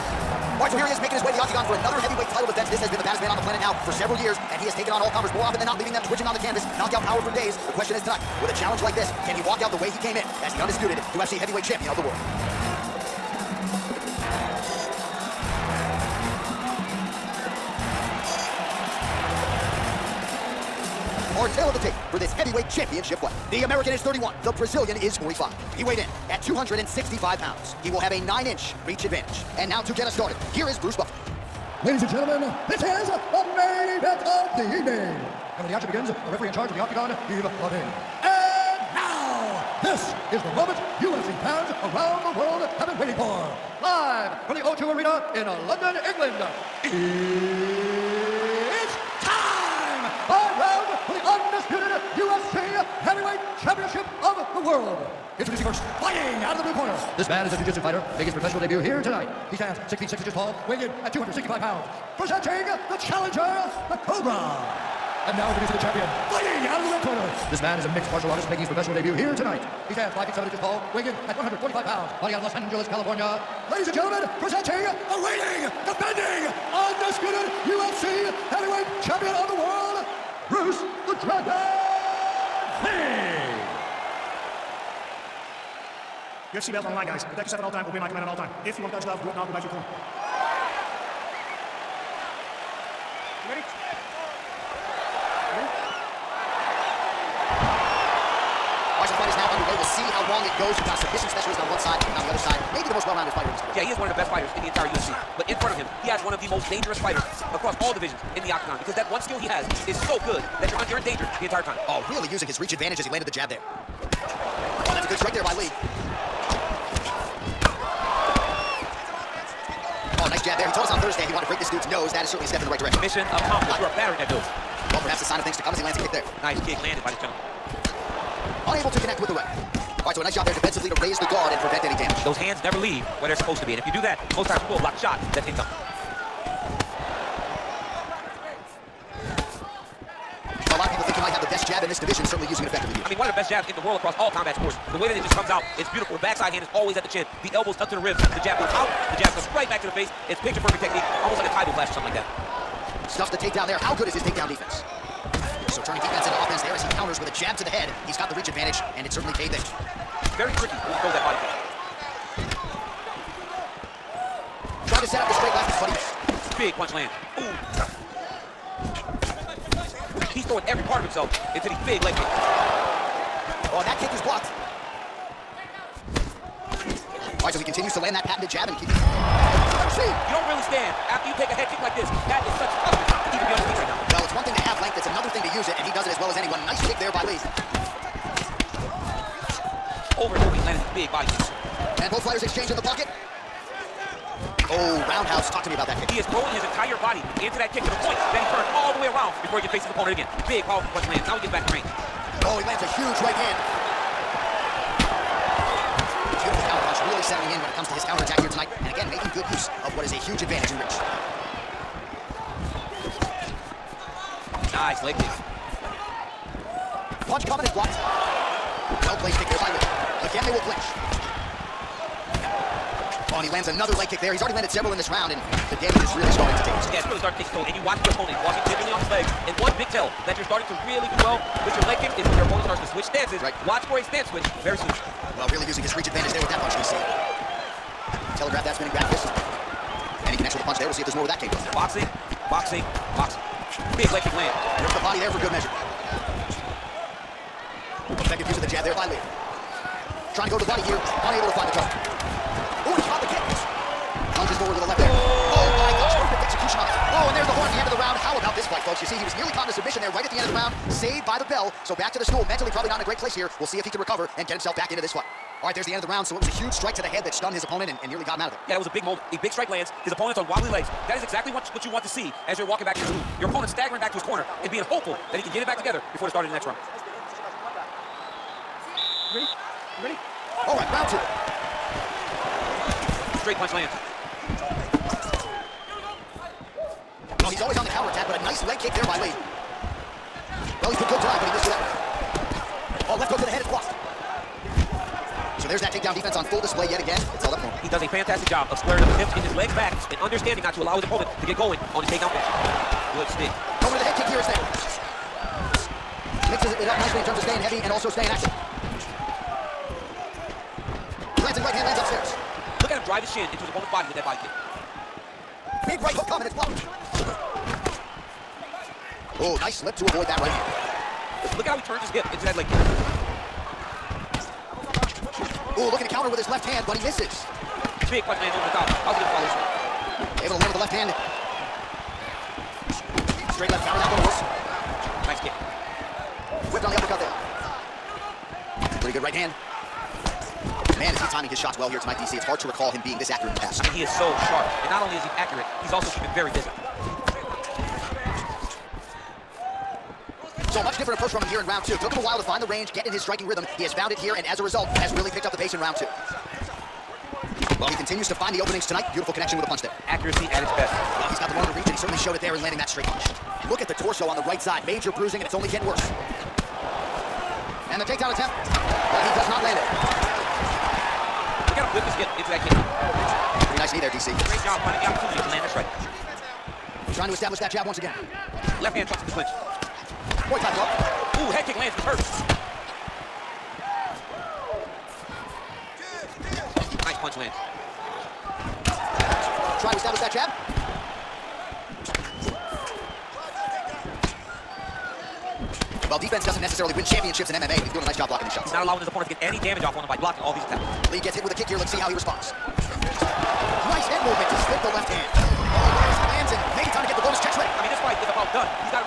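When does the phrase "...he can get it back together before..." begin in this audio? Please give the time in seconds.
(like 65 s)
275 s.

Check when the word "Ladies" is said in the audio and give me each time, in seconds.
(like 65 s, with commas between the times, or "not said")
31 s, 73 s.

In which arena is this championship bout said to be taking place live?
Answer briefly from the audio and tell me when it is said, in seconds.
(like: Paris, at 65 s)
O2 Arena, at 44 s.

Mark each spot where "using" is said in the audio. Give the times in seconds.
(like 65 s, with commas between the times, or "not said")
112 s, 142 s, 235 s.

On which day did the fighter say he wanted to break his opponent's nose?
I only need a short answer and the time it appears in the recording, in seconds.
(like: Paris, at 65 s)
Thursday, at 121 s.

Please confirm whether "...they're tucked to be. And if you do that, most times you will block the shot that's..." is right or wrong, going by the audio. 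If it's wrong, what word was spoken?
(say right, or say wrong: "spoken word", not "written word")
wrong: "supposed", not "tucked".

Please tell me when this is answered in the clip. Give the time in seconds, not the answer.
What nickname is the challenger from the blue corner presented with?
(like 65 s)
63 s.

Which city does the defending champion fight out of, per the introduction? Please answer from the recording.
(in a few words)
Los Angeles, California.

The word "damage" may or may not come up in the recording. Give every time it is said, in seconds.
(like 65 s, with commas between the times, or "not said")
131 s, 225 s, 399 s.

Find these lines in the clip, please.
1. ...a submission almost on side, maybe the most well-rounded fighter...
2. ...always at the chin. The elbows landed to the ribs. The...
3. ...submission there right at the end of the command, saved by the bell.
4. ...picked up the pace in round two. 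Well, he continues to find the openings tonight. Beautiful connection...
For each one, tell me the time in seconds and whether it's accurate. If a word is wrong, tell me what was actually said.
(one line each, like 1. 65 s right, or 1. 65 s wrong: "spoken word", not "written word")
1. 100 s wrong: "specialist", not "almost"
2. 146 s wrong: "tucked", not "landed"
3. 259 s wrong: "round", not "command"
4. 355 s right.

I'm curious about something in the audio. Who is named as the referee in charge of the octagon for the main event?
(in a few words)
Yves Lavigne.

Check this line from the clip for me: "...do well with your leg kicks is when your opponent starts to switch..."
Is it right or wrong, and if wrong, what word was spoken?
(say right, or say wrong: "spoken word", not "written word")
right.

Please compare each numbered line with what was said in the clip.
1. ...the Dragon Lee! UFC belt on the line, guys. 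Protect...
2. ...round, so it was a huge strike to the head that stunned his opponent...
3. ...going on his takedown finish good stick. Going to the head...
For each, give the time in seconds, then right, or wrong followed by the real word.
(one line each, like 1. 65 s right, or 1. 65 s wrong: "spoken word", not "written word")
1. 81 s right
2. 266 s right
3. 301 s right.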